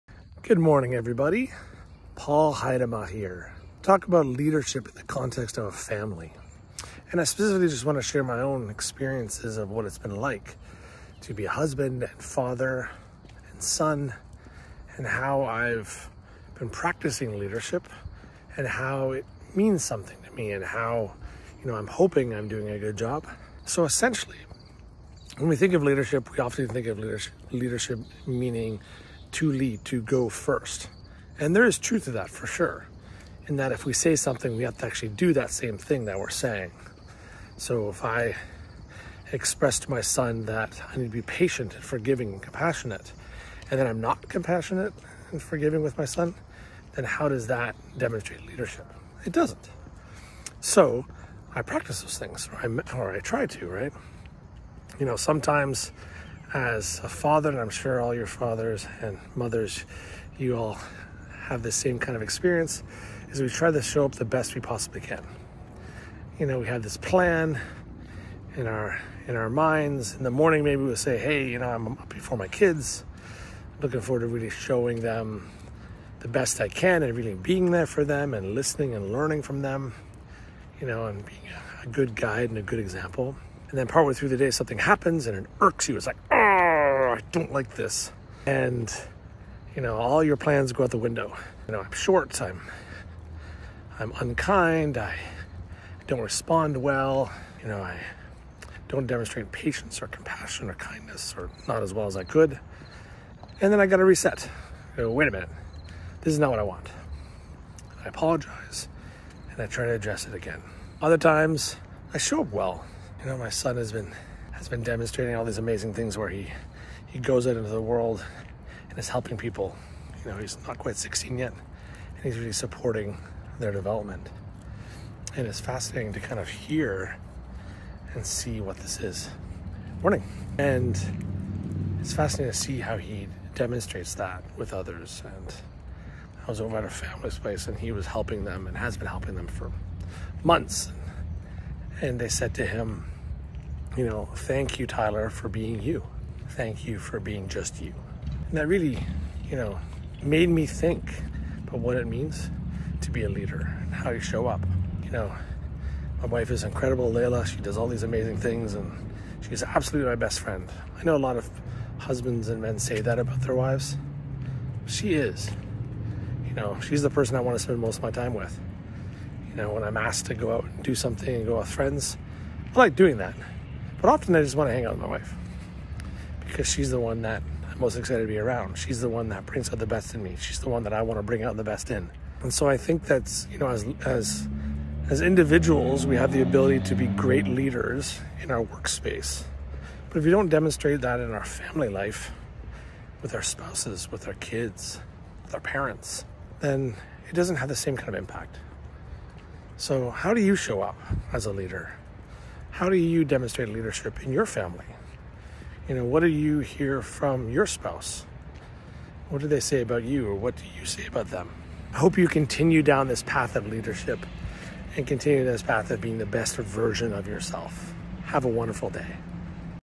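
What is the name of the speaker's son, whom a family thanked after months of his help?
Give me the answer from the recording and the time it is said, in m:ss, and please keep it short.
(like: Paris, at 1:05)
Tyler, at 2:24.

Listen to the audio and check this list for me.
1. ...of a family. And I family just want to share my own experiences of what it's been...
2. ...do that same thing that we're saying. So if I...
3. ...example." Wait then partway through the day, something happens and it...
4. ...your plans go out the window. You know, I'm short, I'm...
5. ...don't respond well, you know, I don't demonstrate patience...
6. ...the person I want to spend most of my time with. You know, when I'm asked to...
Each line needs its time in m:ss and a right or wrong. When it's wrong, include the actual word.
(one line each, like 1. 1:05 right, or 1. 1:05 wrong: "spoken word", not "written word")
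1. 0:05 wrong: "specifically", not "family"
2. 0:35 right
3. 1:22 wrong: "And", not "Wait"
4. 1:30 right
5. 1:36 right
6. 2:47 right.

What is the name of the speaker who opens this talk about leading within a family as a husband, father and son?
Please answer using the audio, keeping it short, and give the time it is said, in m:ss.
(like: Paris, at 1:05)
Paul Heidema, at 0:02.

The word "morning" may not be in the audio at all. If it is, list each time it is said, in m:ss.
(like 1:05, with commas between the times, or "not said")
0:00, 1:10, 2:10.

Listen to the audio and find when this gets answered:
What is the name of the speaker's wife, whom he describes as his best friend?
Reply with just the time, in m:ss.
2:37.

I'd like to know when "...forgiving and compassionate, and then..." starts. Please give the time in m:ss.
0:41.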